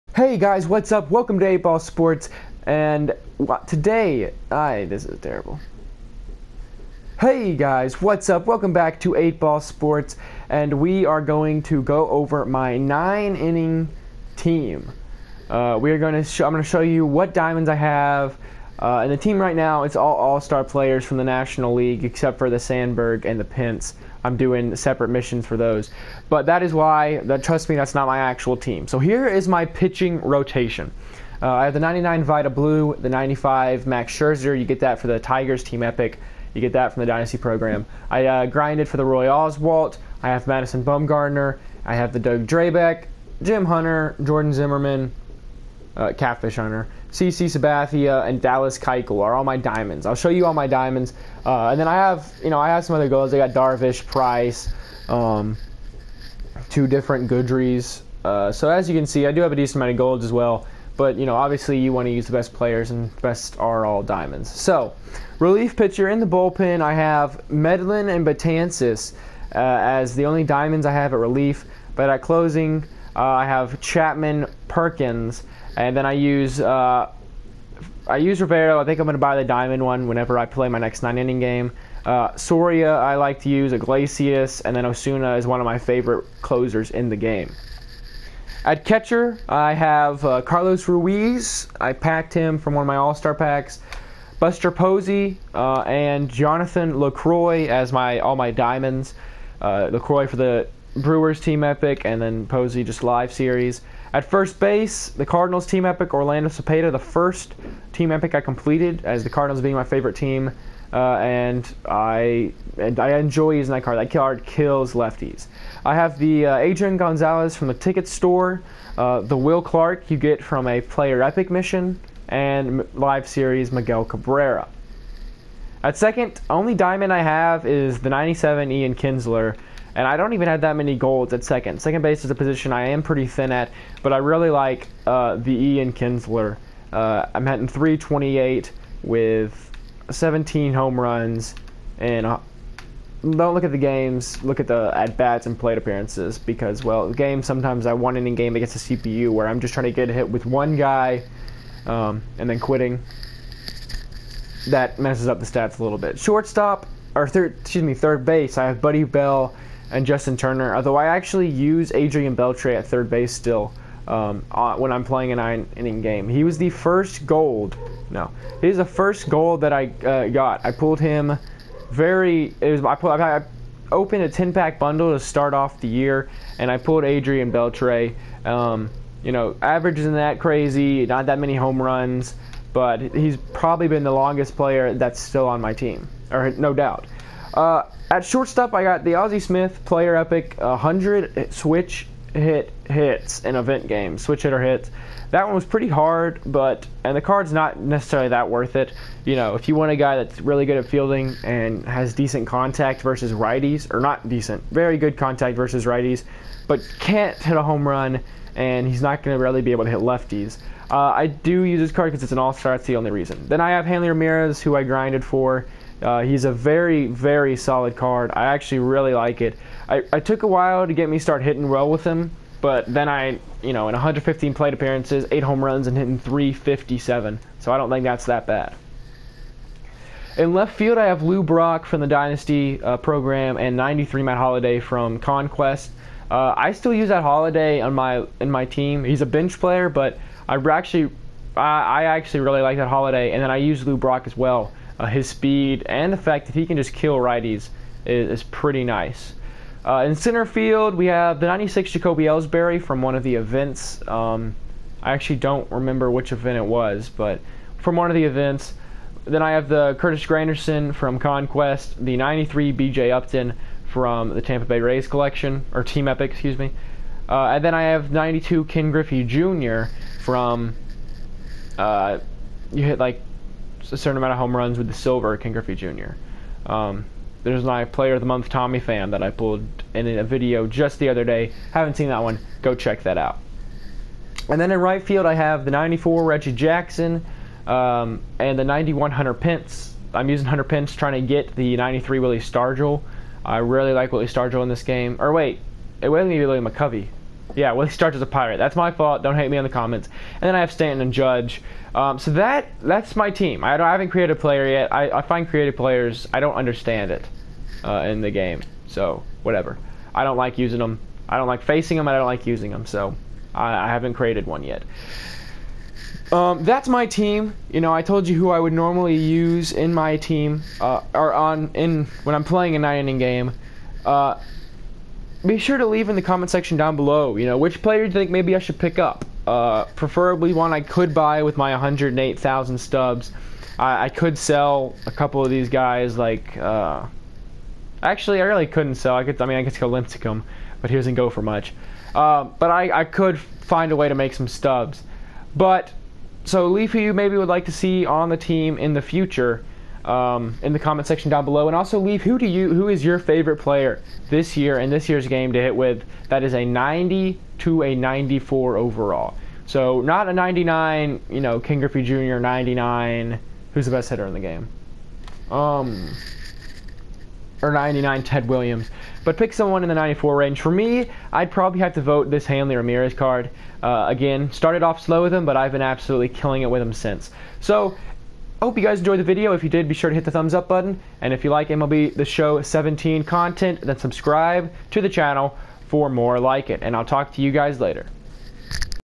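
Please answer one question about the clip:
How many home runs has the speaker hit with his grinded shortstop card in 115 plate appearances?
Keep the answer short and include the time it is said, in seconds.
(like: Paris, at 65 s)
8, at 225 s.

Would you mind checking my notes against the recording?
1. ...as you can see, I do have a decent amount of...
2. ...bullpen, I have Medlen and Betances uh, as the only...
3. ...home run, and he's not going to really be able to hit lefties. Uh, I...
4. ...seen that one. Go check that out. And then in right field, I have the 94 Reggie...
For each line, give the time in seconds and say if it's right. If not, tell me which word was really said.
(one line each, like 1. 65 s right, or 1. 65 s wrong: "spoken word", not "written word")
1. 58 s right
2. 66 s right
3. 207 s right
4. 281 s right.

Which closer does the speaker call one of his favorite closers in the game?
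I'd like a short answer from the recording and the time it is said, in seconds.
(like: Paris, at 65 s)
Osuna, at 84 s.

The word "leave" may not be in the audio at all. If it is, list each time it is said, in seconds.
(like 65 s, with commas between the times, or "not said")
325 s, 346 s, 351 s.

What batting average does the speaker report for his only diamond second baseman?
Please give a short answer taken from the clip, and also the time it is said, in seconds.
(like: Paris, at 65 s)
.328, at 137 s.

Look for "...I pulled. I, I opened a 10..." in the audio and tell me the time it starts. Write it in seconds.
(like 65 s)
172 s.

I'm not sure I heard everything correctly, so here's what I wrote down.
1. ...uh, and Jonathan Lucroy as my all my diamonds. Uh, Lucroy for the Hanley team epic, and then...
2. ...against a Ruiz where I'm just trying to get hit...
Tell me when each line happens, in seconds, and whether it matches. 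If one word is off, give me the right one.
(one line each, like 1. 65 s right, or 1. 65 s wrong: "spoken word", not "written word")
1. 95 s wrong: "Brewers", not "Hanley"
2. 148 s wrong: "CPU", not "Ruiz".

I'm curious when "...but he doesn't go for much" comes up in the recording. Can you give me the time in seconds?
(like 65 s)
340 s.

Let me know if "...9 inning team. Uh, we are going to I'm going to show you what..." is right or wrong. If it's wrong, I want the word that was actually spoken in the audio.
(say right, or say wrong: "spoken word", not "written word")
right.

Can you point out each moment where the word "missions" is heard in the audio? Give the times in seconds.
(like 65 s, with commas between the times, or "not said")
25 s, 121 s.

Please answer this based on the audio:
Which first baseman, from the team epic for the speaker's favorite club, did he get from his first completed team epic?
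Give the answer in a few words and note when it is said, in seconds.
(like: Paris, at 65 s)
Orlando Cepeda, at 106 s.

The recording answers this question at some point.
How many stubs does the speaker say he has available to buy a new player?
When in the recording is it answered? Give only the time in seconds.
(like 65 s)
331 s.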